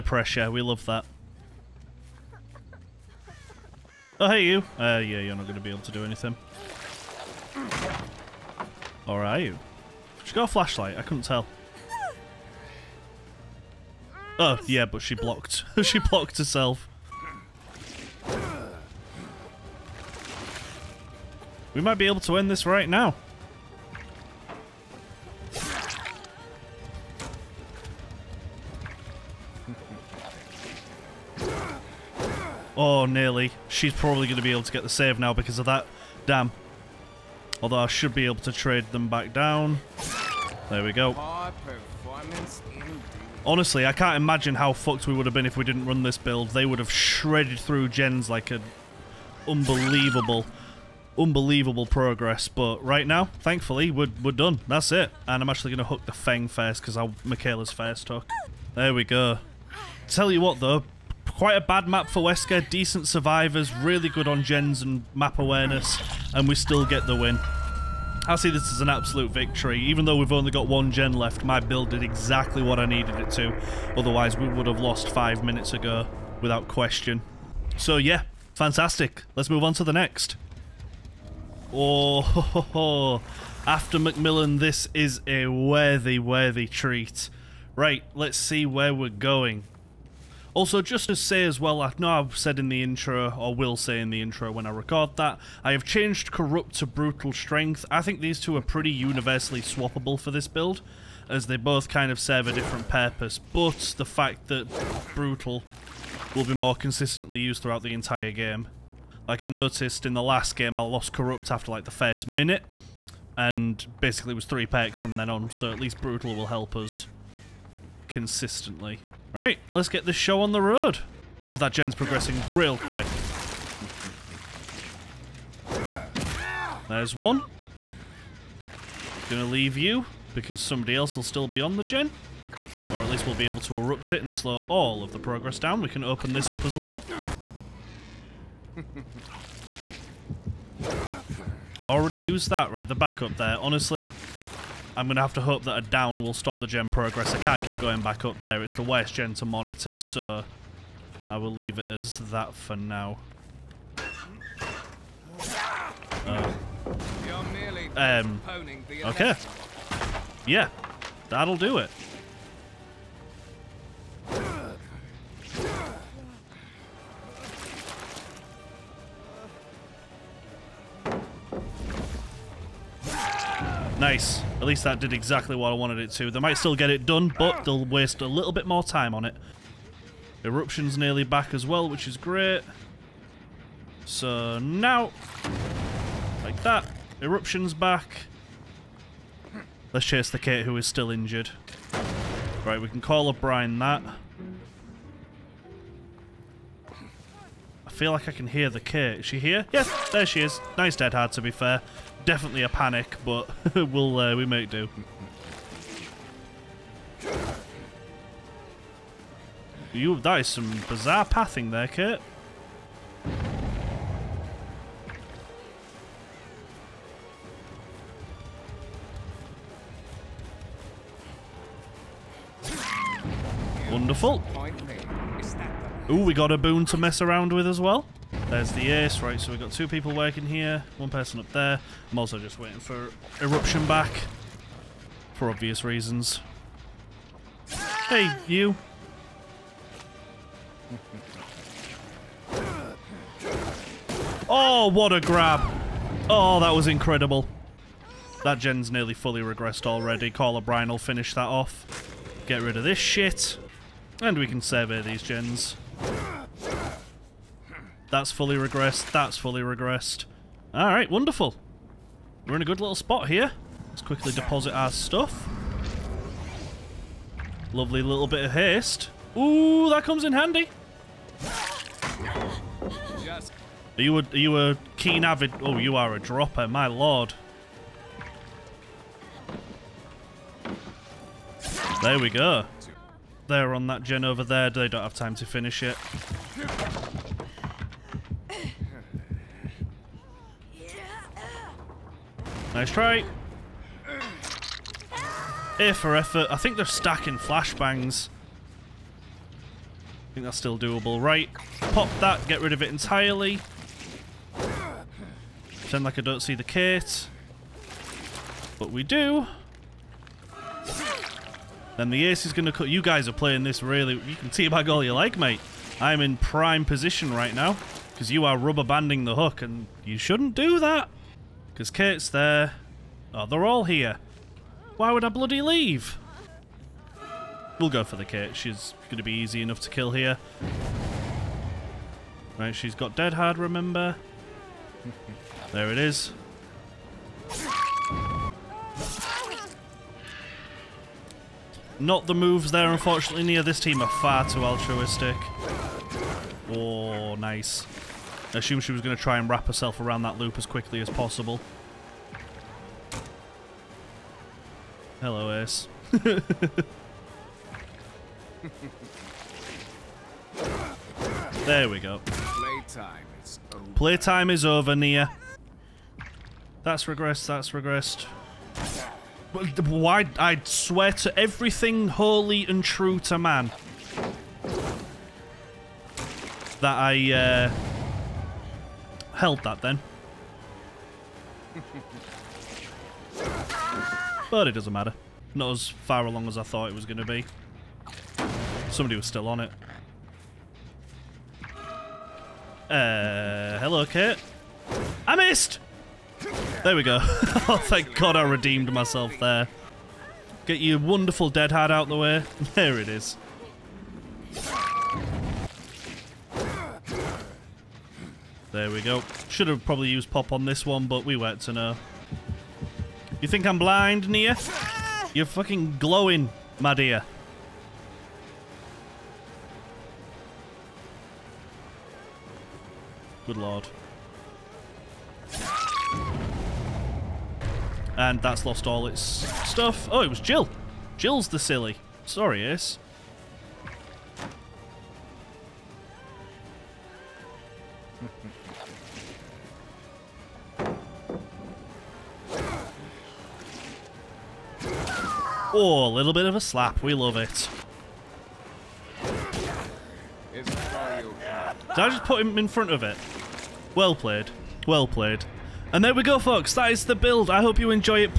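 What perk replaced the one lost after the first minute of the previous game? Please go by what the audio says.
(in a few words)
Brutal Strength.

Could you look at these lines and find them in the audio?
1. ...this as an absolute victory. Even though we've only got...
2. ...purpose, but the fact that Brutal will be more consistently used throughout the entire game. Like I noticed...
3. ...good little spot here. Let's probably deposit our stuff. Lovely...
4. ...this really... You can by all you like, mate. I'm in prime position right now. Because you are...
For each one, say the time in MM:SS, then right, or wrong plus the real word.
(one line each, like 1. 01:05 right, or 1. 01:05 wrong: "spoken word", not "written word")
1. 01:08 right
2. 01:42 right
3. 04:22 wrong: "quickly", not "probably"
4. 05:13 right.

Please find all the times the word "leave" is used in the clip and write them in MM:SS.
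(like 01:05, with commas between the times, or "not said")
02:09, 02:31, 05:25.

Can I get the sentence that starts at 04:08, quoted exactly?
That gen's nearly fully regressed already.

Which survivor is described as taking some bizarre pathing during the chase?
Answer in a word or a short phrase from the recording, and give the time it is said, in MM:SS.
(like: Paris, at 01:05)
Kurt, at 03:31.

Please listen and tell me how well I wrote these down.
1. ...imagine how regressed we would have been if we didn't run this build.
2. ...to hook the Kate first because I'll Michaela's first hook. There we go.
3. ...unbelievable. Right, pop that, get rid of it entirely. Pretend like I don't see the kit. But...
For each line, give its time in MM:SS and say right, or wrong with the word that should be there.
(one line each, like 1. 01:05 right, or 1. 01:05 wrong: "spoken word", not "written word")
1. 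00:44 wrong: "fucked", not "regressed"
2. 00:55 wrong: "Feng", not "Kate"
3. 05:00 wrong: "doable", not "unbelievable".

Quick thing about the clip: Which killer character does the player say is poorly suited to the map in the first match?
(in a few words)
Wesker.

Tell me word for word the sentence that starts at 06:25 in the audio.
Not as far along as I thought it was going to be.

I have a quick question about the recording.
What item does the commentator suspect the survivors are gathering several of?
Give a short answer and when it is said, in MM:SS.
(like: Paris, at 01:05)
Flashbangs, at 04:57.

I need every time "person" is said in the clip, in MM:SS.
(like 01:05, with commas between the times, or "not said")
03:51.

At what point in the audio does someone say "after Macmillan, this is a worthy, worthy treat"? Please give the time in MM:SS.
01:23.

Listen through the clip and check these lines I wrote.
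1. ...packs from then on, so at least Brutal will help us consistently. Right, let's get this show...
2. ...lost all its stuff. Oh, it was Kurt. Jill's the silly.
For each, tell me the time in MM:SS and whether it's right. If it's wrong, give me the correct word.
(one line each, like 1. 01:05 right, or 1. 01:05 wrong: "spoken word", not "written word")
1. 01:54 right
2. 07:08 wrong: "Jill", not "Kurt".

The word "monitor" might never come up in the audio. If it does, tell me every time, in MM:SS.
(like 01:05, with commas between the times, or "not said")
02:29.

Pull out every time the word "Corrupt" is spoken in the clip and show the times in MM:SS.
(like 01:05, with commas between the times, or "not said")
01:36, 01:51.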